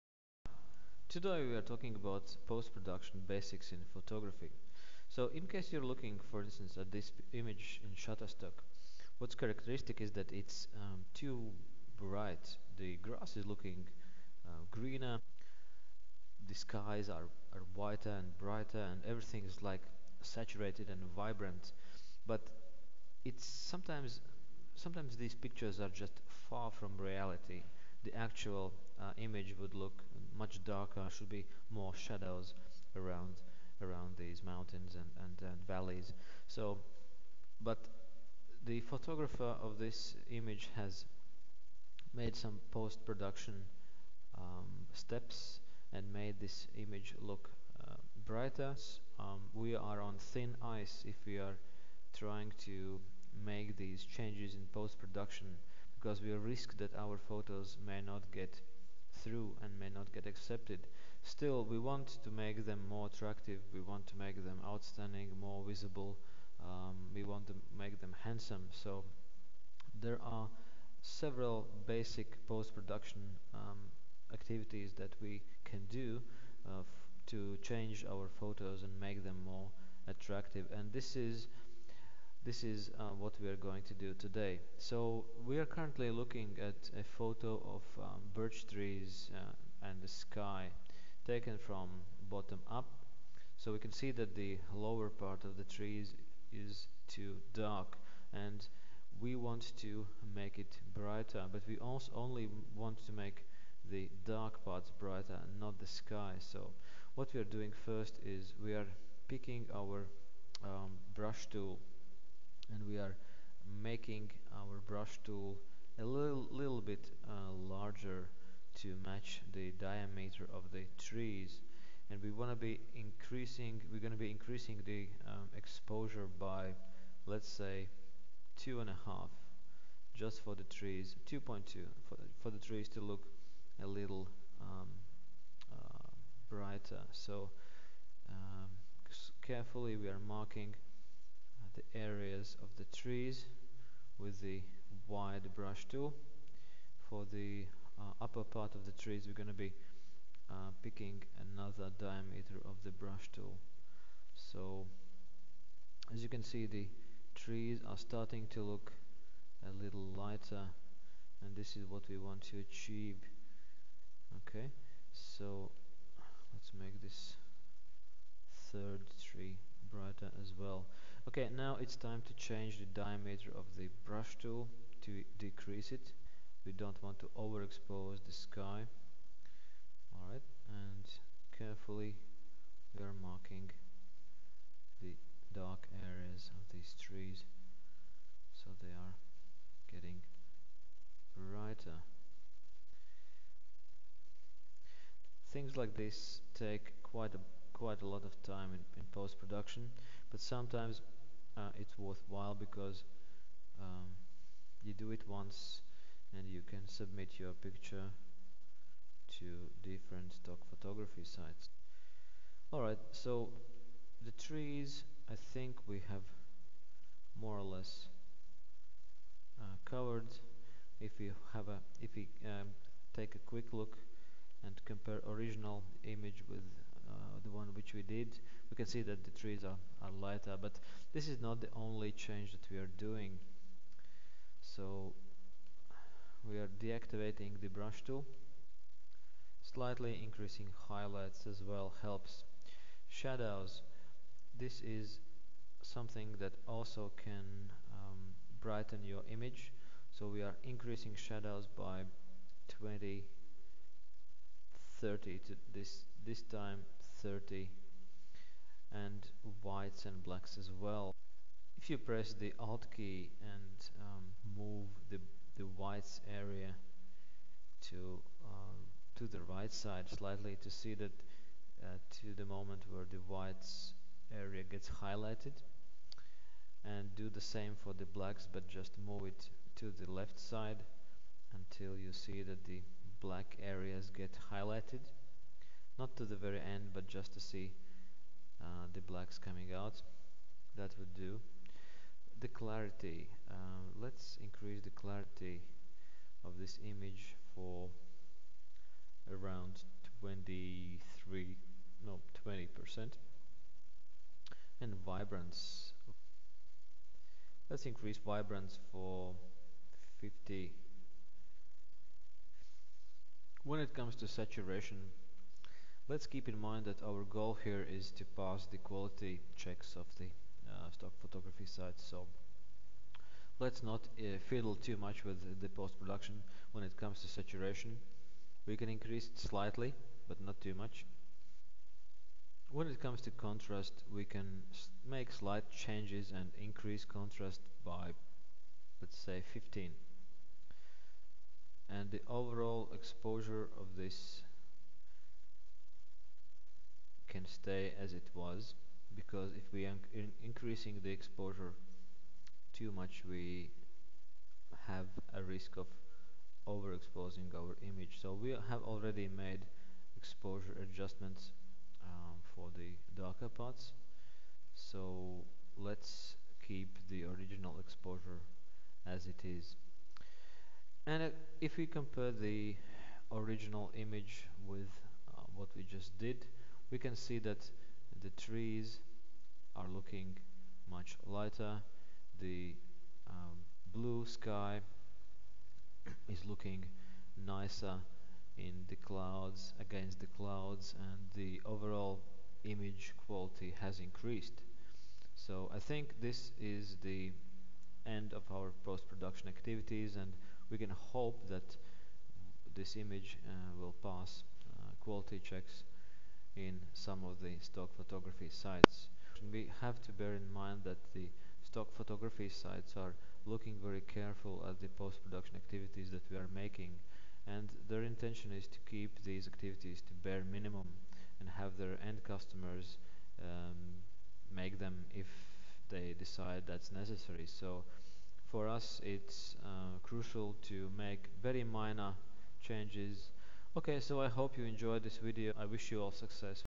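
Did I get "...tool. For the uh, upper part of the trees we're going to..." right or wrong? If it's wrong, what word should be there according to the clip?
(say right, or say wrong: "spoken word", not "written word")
right.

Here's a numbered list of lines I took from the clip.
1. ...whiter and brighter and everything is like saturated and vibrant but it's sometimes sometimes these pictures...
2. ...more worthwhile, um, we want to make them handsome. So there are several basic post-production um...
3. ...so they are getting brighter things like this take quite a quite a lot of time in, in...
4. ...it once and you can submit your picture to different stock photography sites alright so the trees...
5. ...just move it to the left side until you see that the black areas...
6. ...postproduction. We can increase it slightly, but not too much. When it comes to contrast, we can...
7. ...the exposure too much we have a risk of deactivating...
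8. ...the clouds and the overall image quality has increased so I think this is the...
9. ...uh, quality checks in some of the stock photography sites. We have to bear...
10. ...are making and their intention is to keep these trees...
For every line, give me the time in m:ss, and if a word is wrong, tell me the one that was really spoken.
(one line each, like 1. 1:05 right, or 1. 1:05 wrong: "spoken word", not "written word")
1. 0:17 right
2. 1:05 wrong: "visible", not "worthwhile"
3. 3:08 right
4. 3:25 right
5. 4:38 right
6. 5:27 wrong: "saturation", not "postproduction"
7. 5:51 wrong: "overexposing", not "deactivating"
8. 6:30 right
9. 6:44 right
10. 6:56 wrong: "activities", not "trees".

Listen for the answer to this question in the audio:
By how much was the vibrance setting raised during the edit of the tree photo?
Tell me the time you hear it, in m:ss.
5:10.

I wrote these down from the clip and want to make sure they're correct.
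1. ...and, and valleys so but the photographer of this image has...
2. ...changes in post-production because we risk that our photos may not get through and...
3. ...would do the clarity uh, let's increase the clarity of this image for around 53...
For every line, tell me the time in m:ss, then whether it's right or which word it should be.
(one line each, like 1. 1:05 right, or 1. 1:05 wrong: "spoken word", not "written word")
1. 0:35 right
2. 0:54 right
3. 4:50 wrong: "23", not "53".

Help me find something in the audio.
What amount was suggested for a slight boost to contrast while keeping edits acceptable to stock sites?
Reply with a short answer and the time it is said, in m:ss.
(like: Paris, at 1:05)
15, at 5:39.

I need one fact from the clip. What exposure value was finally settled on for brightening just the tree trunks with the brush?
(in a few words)
2.2.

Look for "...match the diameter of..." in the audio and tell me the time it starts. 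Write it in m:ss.
1:59.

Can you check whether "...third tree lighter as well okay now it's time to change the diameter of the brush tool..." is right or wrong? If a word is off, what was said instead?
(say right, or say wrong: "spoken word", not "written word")
wrong: "brighter", not "lighter".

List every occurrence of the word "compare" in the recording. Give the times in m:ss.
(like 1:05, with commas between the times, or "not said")
3:44, 6:11.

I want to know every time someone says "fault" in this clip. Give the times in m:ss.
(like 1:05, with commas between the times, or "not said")
not said.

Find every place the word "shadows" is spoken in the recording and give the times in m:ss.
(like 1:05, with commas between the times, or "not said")
0:31, 4:03, 4:11.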